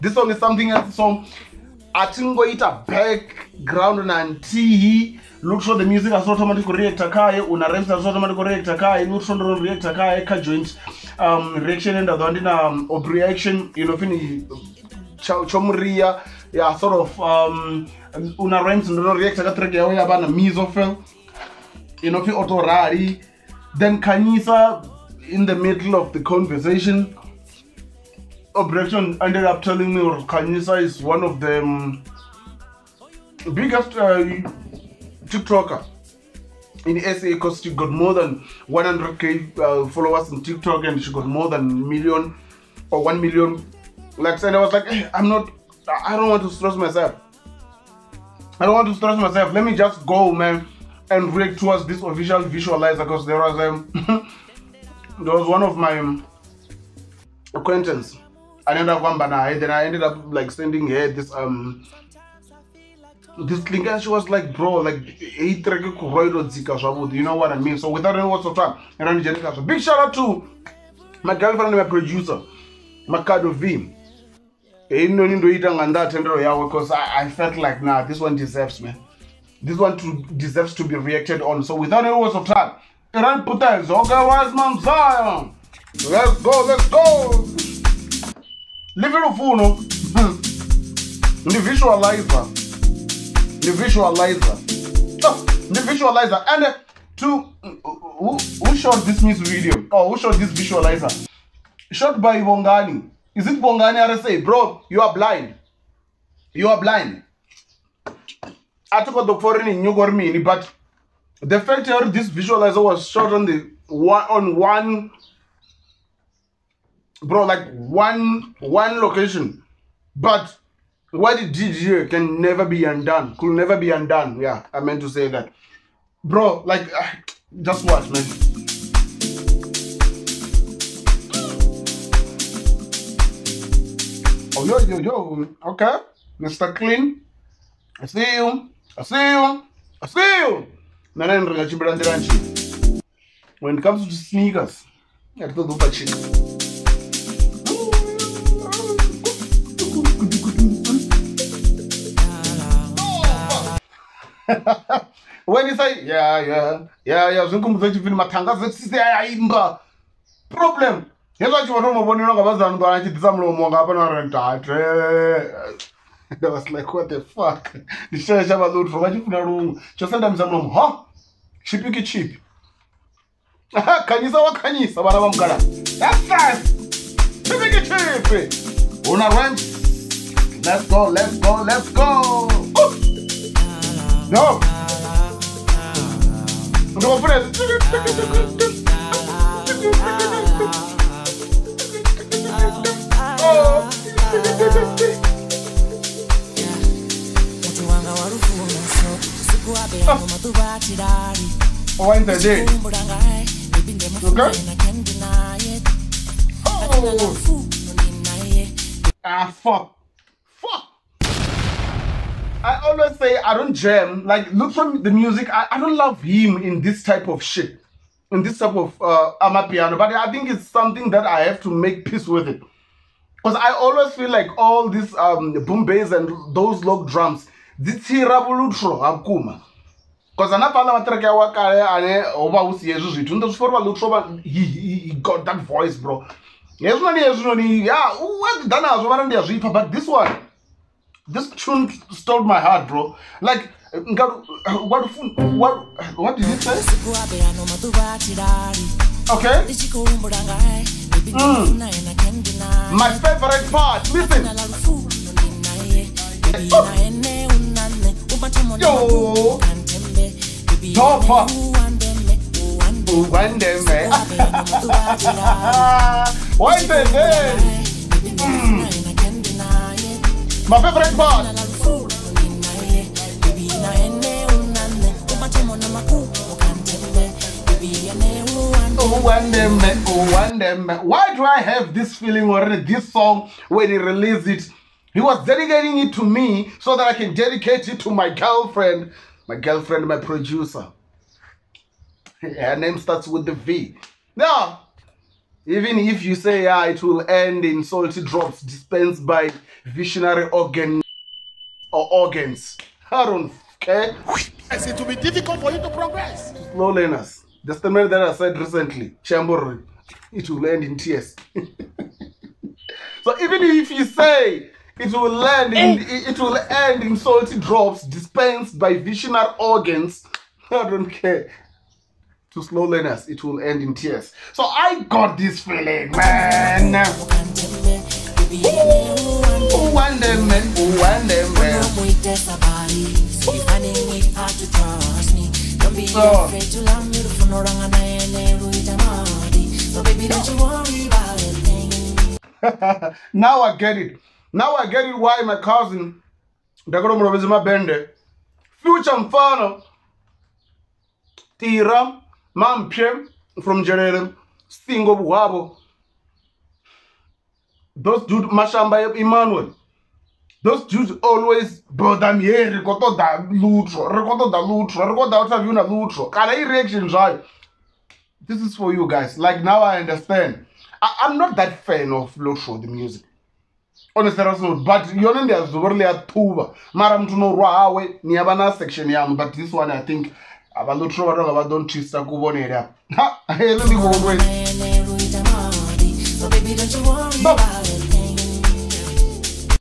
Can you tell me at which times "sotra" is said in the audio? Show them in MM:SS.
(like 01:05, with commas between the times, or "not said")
01:08, 01:22.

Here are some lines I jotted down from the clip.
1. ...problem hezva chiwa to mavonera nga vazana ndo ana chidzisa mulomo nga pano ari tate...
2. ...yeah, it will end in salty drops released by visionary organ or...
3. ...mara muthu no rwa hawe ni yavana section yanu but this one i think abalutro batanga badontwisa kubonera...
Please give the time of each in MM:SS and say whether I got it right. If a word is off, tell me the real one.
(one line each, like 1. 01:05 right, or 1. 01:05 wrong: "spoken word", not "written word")
1. 02:40 right
2. 04:56 wrong: "dispensed", not "released"
3. 06:16 right.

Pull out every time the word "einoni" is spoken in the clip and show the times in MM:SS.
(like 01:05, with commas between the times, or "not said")
01:14.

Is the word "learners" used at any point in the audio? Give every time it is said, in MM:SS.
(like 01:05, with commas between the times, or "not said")
05:06, 05:22.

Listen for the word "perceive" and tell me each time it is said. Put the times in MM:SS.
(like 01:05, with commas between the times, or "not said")
not said.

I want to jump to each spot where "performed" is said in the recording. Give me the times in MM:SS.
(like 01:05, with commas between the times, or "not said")
not said.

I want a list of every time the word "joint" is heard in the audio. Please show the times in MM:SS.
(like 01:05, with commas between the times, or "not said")
00:10.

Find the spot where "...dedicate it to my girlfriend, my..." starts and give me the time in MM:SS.
04:47.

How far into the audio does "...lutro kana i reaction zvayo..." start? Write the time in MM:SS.
06:05.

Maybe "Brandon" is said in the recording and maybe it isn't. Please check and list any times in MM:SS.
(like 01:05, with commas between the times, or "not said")
not said.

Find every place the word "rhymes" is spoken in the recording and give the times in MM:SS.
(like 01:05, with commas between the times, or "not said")
00:18.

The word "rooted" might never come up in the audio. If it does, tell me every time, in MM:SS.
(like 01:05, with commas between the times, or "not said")
not said.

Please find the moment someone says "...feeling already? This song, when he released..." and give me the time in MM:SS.
04:42.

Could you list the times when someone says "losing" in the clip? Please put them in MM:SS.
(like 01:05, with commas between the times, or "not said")
not said.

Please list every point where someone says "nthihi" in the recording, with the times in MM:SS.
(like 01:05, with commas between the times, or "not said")
00:04.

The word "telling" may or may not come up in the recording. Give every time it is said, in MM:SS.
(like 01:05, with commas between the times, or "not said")
00:29.